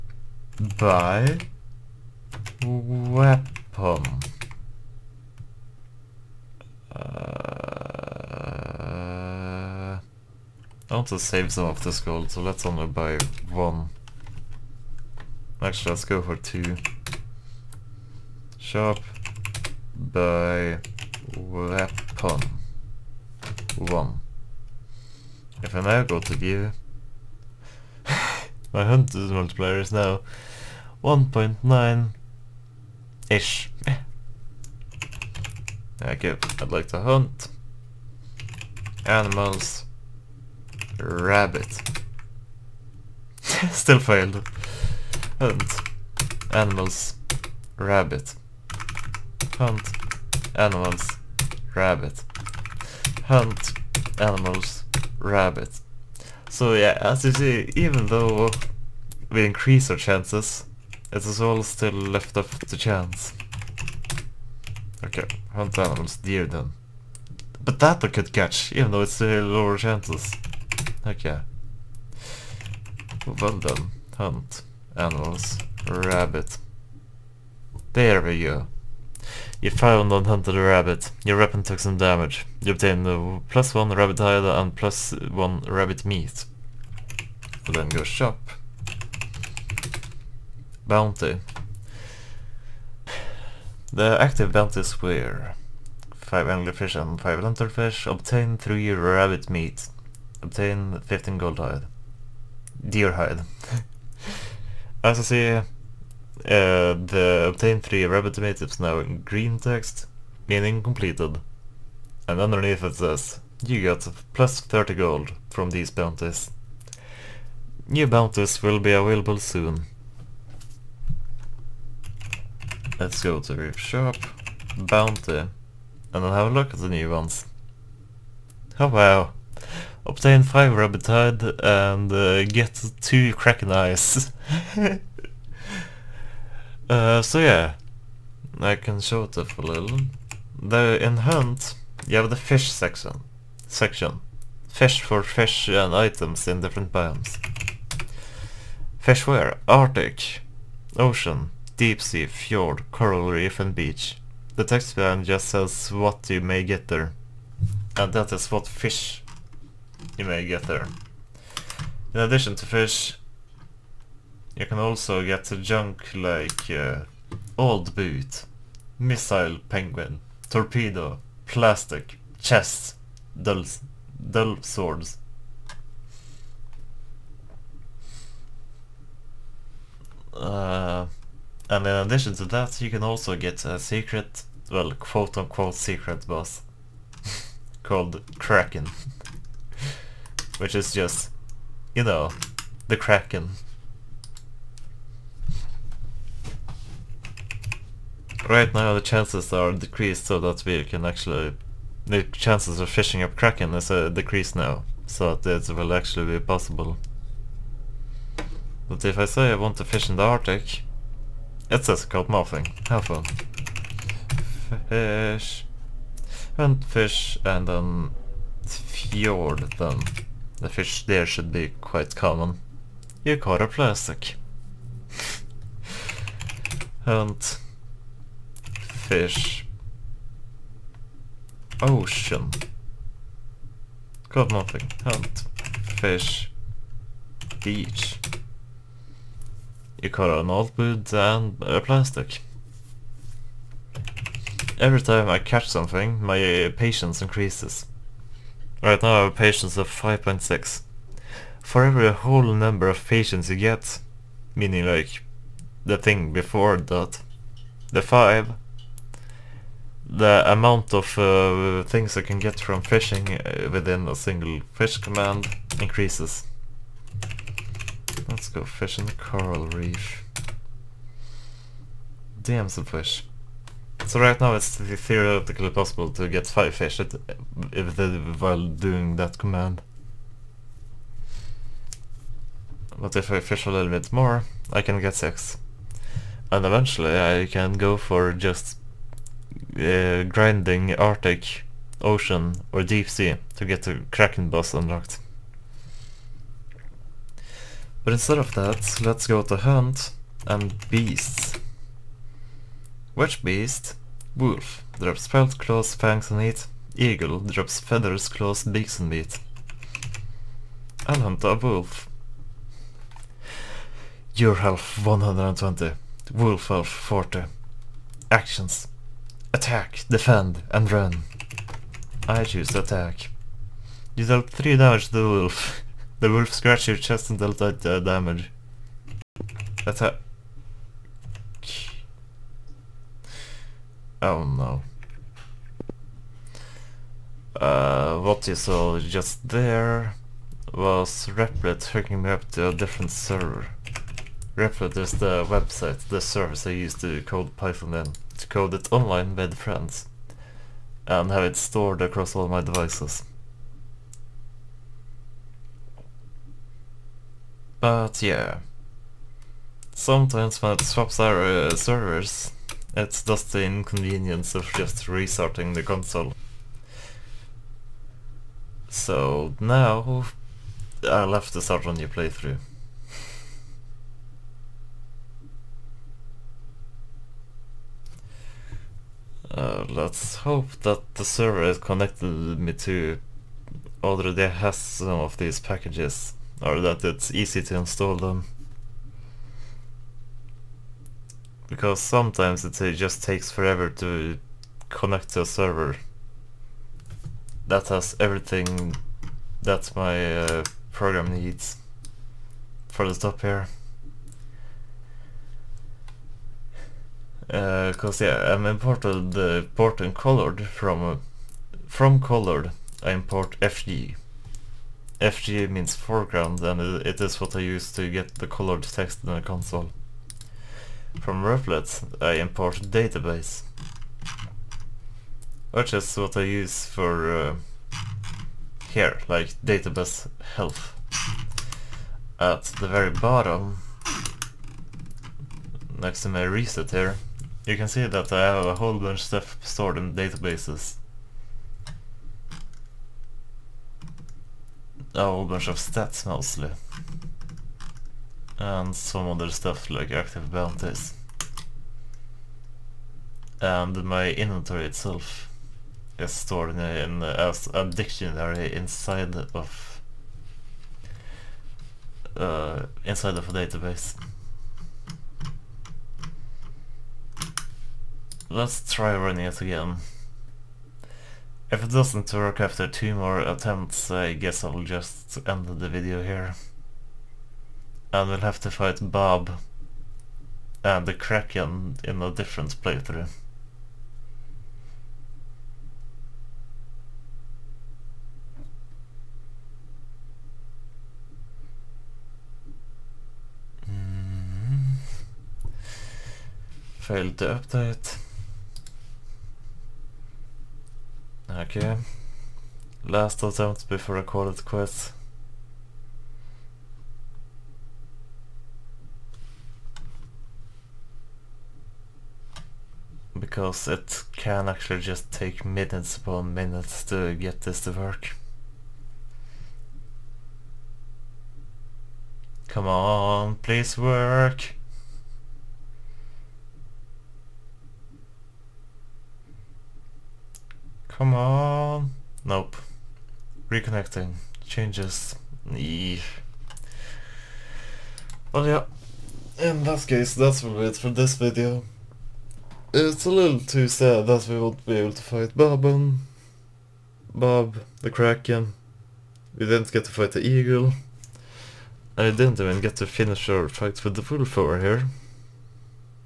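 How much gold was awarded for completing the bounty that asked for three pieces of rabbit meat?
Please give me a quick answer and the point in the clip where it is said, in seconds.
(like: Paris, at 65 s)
30 gold, at 114 s.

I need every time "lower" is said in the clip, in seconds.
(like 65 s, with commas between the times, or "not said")
69 s.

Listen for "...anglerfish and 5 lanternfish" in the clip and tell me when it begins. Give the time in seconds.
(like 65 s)
96 s.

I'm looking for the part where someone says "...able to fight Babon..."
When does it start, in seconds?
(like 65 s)
544 s.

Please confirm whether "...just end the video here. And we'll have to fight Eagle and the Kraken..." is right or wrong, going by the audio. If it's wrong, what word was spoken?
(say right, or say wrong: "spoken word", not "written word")
wrong: "Bob", not "Eagle".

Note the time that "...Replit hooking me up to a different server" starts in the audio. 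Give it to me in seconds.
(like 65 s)
341 s.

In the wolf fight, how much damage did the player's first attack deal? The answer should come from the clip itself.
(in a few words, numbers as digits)
3 damage.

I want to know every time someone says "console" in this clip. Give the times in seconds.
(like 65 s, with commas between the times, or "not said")
365 s, 419 s.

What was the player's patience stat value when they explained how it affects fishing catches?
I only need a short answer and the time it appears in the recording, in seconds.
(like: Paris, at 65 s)
5.6, at 249 s.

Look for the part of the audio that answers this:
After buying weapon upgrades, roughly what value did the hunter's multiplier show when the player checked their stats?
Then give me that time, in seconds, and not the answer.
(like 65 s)
31 s.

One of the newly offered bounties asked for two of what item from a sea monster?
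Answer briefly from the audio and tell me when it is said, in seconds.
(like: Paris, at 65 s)
Kraken Eyes, at 133 s.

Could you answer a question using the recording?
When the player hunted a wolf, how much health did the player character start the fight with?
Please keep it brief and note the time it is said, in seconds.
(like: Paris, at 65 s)
120, at 315 s.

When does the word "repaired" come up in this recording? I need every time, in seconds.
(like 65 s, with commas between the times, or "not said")
not said.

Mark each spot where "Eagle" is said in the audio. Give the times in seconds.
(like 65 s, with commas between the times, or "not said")
306 s, 550 s.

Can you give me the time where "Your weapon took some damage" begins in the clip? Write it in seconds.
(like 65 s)
81 s.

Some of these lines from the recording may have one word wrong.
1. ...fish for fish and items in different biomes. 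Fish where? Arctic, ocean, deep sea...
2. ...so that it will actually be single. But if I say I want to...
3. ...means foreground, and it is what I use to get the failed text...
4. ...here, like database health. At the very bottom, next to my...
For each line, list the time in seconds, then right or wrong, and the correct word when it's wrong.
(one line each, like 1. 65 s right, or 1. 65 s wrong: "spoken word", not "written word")
1. 144 s right
2. 205 s wrong: "possible", not "single"
3. 415 s wrong: "colored", not "failed"
4. 428 s right.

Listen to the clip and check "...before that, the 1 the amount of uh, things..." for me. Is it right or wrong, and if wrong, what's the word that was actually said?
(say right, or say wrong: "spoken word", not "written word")
wrong: "5", not "1".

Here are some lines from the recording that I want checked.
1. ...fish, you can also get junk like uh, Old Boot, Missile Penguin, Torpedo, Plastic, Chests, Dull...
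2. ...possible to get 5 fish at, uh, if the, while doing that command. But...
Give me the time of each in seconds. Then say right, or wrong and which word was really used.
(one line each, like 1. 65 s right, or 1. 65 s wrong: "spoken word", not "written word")
1. 162 s right
2. 275 s right.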